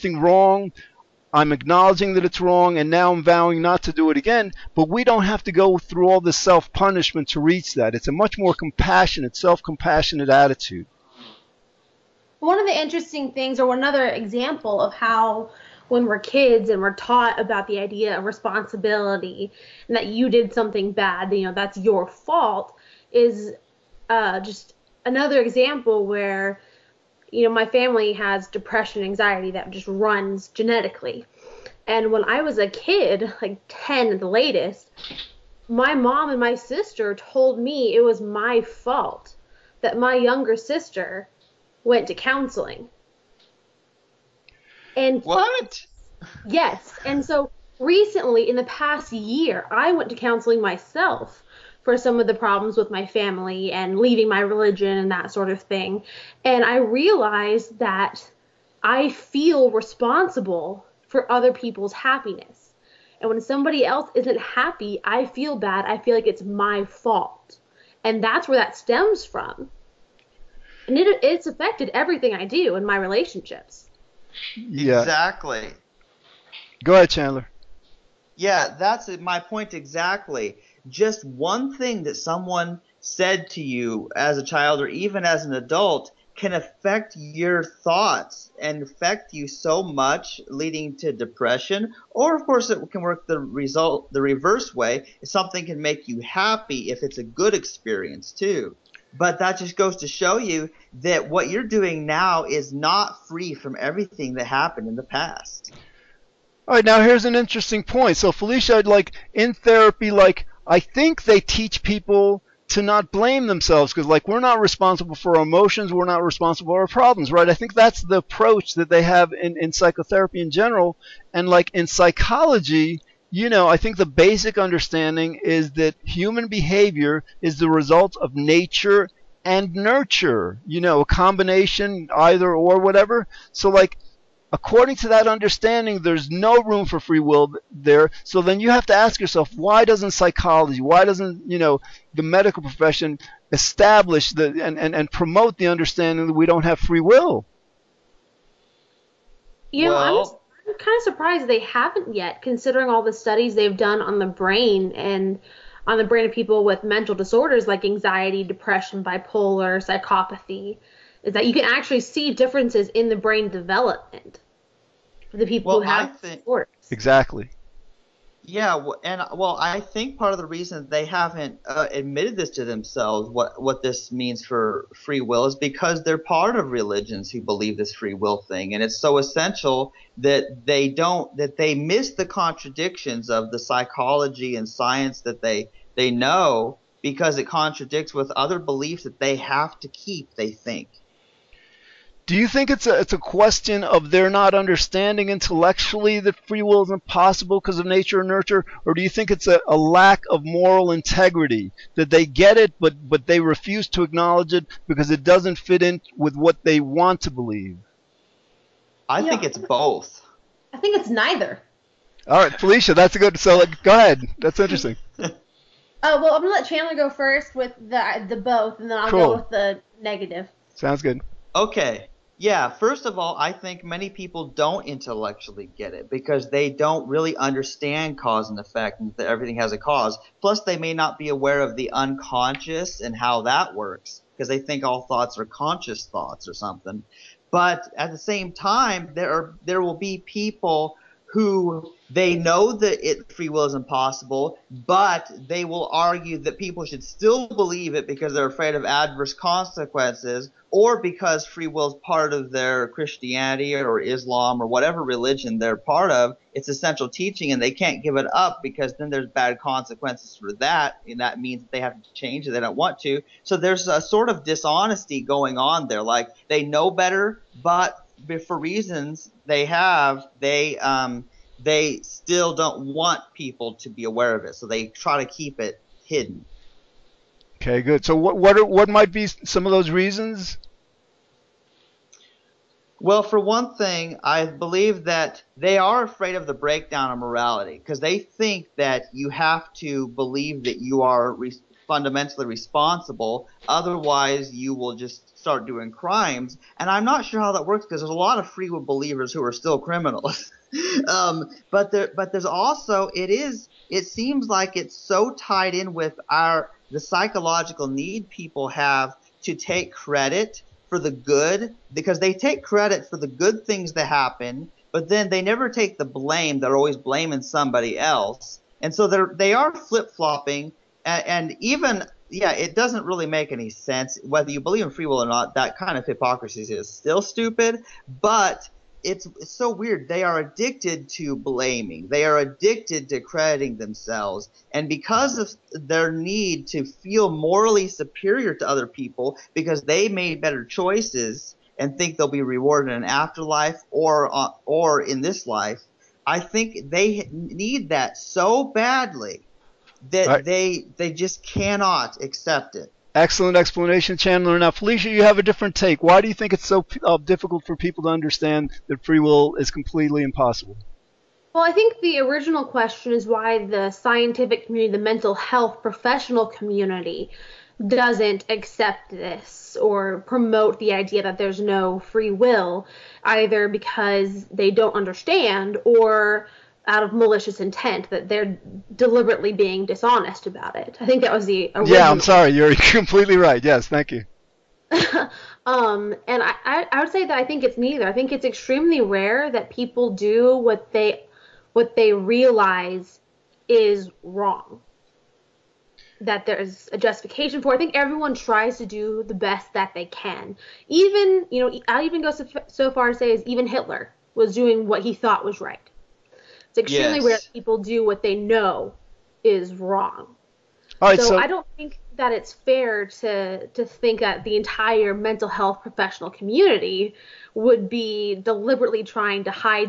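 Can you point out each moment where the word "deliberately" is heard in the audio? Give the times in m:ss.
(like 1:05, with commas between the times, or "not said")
6:18, 6:58.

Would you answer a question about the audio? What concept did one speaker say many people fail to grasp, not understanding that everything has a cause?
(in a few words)
cause and effect.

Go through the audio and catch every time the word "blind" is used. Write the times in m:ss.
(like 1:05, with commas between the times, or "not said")
not said.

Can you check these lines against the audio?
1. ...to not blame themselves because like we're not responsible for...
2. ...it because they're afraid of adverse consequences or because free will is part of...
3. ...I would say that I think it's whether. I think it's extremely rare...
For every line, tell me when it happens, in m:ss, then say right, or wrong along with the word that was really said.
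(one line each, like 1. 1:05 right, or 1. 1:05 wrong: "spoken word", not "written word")
1. 1:52 right
2. 4:07 right
3. 6:26 wrong: "neither", not "whether".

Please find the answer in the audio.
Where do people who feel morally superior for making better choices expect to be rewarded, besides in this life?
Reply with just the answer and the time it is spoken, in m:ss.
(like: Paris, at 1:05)
an afterlife, at 5:43.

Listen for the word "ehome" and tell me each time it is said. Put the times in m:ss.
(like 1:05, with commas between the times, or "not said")
not said.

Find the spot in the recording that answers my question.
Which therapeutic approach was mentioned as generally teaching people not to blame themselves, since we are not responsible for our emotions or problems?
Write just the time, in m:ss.
1:59.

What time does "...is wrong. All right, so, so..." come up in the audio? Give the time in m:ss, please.
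6:49.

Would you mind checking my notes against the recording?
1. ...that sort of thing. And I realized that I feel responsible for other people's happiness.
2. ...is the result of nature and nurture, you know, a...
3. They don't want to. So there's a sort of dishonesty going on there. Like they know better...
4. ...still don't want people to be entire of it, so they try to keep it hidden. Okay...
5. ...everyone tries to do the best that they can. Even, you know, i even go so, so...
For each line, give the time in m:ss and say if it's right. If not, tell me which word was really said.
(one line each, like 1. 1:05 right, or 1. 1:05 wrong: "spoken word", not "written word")
1. 0:55 right
2. 2:07 right
3. 4:22 right
4. 4:32 wrong: "aware", not "entire"
5. 6:37 right.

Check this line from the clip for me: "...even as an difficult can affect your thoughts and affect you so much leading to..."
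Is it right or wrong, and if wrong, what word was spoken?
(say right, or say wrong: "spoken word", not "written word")
wrong: "adult", not "difficult".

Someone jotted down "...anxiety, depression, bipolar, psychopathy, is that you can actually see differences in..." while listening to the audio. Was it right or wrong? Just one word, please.
right.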